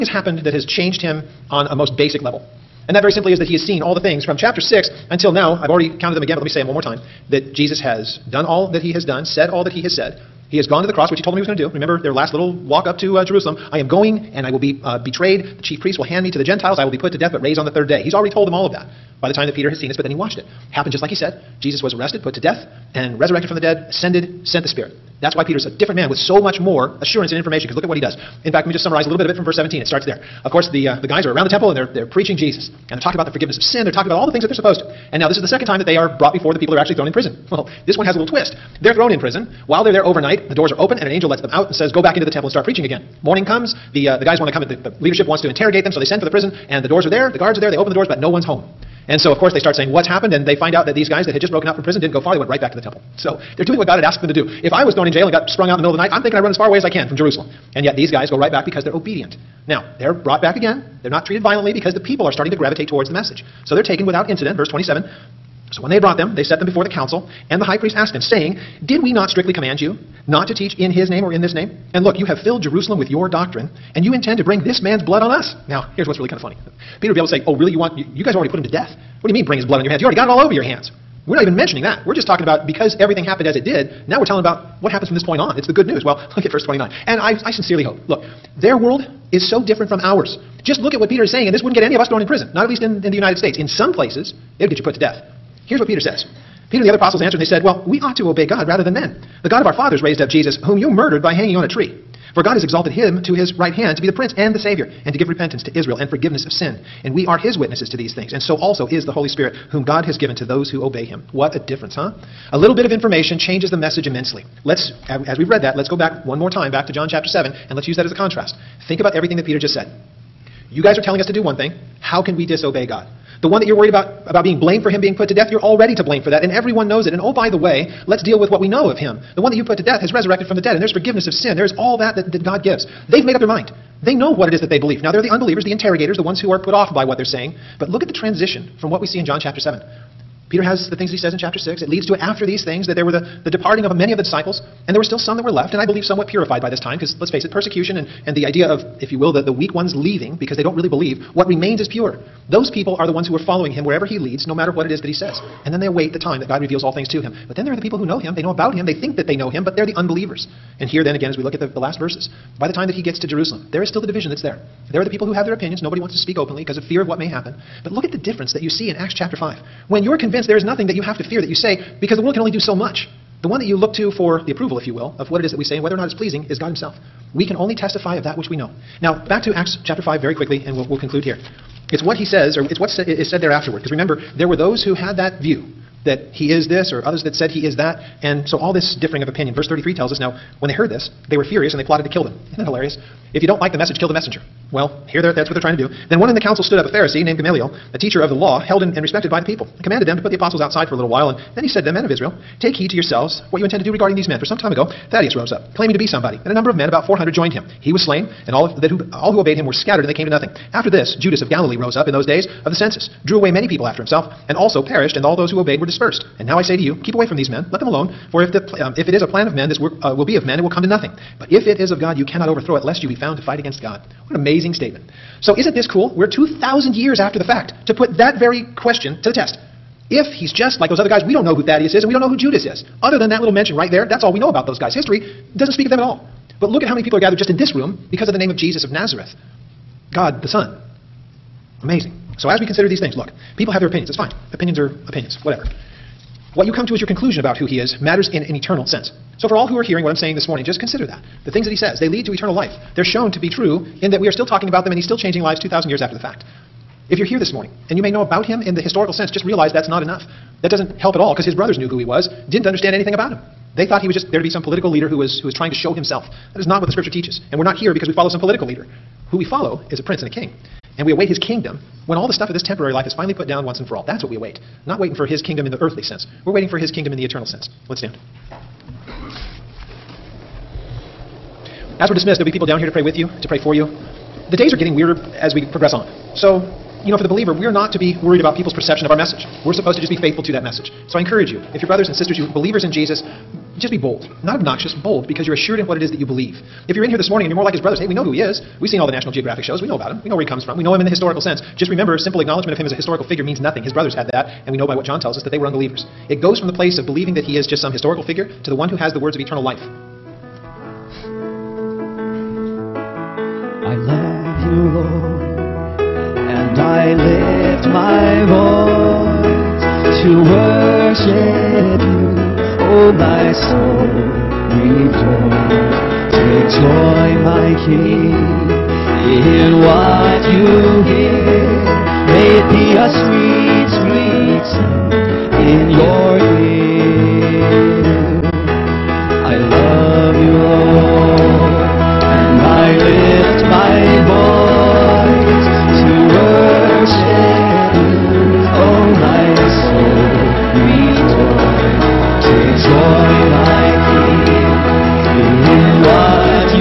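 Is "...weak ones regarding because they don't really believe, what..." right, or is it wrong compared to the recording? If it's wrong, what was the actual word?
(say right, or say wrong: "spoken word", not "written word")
wrong: "leaving", not "regarding".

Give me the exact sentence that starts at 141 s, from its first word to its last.
It leads to it after these things that there were the, the departing of many of the disciples.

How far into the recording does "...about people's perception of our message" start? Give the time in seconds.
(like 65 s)
288 s.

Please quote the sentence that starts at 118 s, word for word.
Think about everything that Peter just said.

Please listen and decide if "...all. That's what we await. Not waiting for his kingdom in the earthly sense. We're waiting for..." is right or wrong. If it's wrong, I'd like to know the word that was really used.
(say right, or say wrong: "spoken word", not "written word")
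right.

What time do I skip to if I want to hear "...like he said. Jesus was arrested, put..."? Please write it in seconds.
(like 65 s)
21 s.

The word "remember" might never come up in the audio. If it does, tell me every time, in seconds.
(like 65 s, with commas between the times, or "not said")
11 s, 183 s, 301 s.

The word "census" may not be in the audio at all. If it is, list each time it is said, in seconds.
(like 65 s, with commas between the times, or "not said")
212 s.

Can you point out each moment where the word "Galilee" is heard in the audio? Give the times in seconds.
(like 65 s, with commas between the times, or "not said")
211 s.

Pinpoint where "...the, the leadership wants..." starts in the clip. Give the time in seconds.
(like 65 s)
44 s.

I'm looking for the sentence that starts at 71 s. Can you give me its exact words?
And look, you have filled Jerusalem with your doctrine, and you intend to bring this man's blood on us.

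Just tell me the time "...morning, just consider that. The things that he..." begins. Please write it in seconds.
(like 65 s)
250 s.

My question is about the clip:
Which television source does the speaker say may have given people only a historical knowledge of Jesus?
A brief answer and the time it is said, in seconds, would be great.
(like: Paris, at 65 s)
National Geographic, at 299 s.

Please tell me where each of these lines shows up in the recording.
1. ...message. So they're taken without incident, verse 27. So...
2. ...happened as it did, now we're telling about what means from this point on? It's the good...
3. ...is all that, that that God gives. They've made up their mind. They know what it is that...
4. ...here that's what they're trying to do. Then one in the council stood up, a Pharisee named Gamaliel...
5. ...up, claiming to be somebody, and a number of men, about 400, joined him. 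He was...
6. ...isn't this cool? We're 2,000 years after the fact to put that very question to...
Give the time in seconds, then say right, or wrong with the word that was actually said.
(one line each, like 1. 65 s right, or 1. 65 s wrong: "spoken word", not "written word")
1. 63 s right
2. 83 s wrong: "happens", not "means"
3. 131 s right
4. 195 s right
5. 205 s right
6. 225 s right.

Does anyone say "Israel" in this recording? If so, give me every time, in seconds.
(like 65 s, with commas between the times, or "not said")
105 s, 202 s.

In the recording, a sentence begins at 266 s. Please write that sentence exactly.
That is not what the scripture teaches.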